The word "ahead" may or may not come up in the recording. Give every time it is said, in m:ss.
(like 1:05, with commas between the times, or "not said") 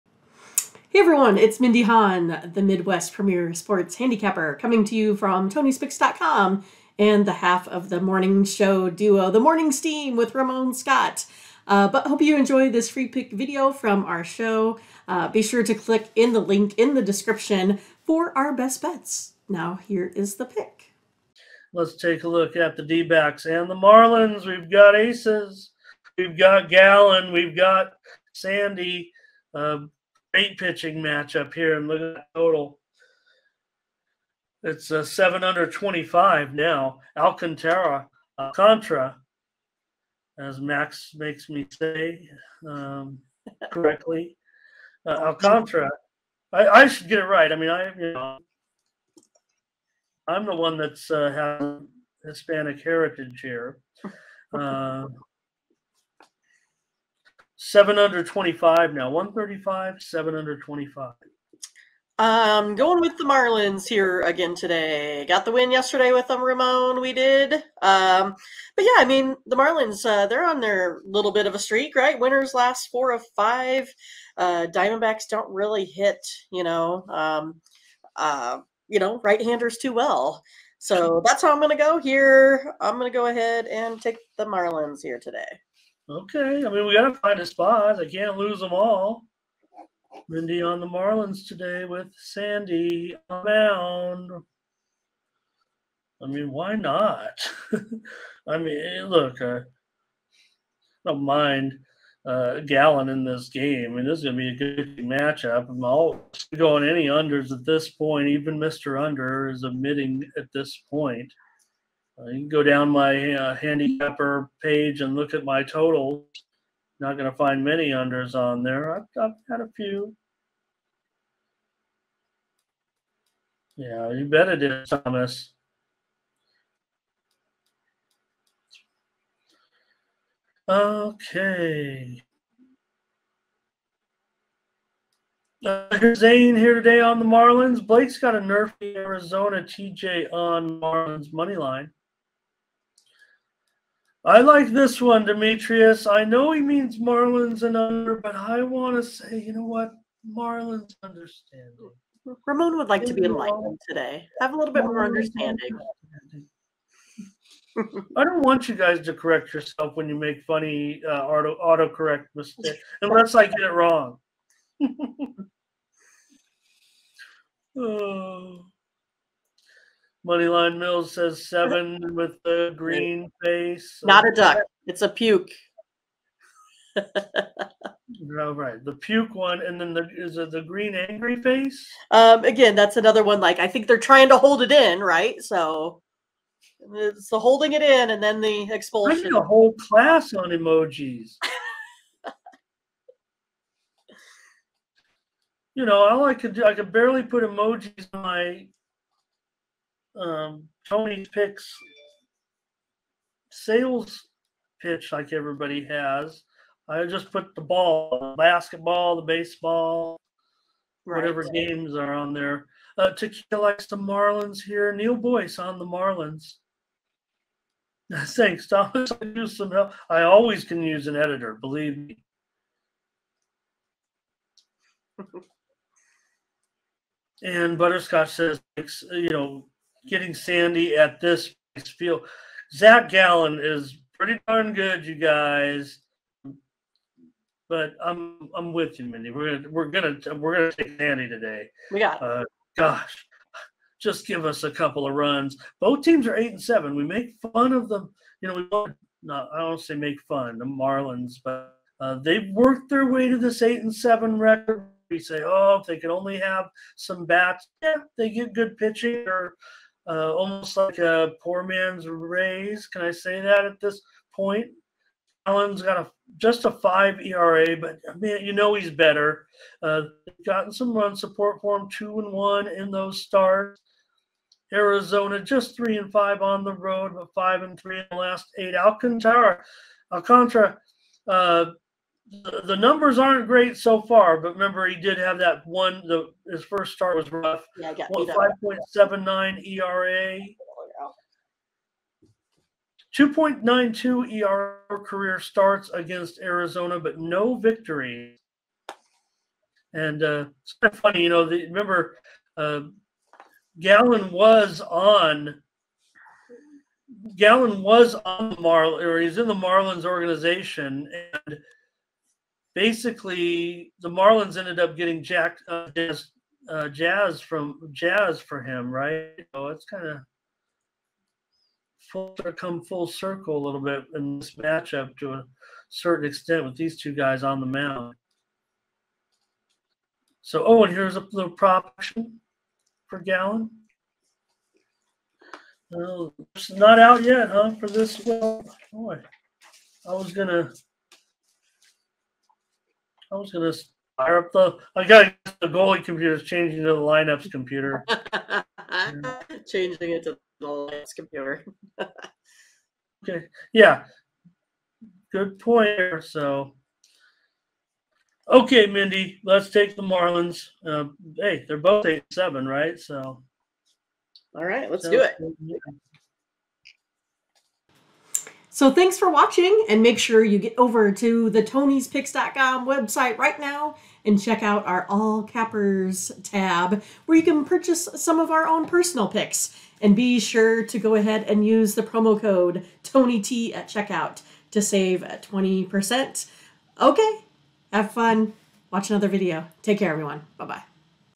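1:23, 6:21.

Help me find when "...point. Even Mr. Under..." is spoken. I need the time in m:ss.
1:47.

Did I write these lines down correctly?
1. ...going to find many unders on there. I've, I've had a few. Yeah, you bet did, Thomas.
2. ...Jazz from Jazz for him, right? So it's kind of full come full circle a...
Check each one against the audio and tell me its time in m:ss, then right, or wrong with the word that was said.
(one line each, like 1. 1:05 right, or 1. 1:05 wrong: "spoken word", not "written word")
1. 1:57 right
2. 5:16 right.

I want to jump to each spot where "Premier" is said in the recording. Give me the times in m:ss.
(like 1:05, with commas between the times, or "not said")
0:03.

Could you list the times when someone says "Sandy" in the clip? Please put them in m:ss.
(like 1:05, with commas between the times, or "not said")
0:28, 1:32, 3:50, 4:00.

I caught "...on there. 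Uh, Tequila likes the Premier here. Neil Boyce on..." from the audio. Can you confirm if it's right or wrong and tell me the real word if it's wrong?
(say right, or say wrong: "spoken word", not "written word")
wrong: "Marlins", not "Premier".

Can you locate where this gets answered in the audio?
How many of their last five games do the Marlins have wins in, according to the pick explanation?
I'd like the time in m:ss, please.
1:12.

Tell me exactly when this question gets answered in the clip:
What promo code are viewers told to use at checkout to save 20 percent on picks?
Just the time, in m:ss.
6:23.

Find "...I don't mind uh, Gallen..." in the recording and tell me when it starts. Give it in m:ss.
1:39.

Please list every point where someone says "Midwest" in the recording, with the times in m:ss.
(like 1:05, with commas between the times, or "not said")
0:02.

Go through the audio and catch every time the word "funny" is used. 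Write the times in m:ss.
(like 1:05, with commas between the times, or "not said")
2:40, 5:01.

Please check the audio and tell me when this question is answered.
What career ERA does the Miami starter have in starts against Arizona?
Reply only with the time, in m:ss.
4:53.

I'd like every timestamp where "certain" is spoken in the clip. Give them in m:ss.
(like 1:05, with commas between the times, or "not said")
5:25.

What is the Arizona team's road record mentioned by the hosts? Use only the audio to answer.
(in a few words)
3 and 5.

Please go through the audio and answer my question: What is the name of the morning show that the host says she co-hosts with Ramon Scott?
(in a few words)
The Morning Steam.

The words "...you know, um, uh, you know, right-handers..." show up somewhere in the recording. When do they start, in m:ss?
1:16.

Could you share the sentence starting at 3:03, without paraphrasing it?
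Like I think they're trying to hold it in, right?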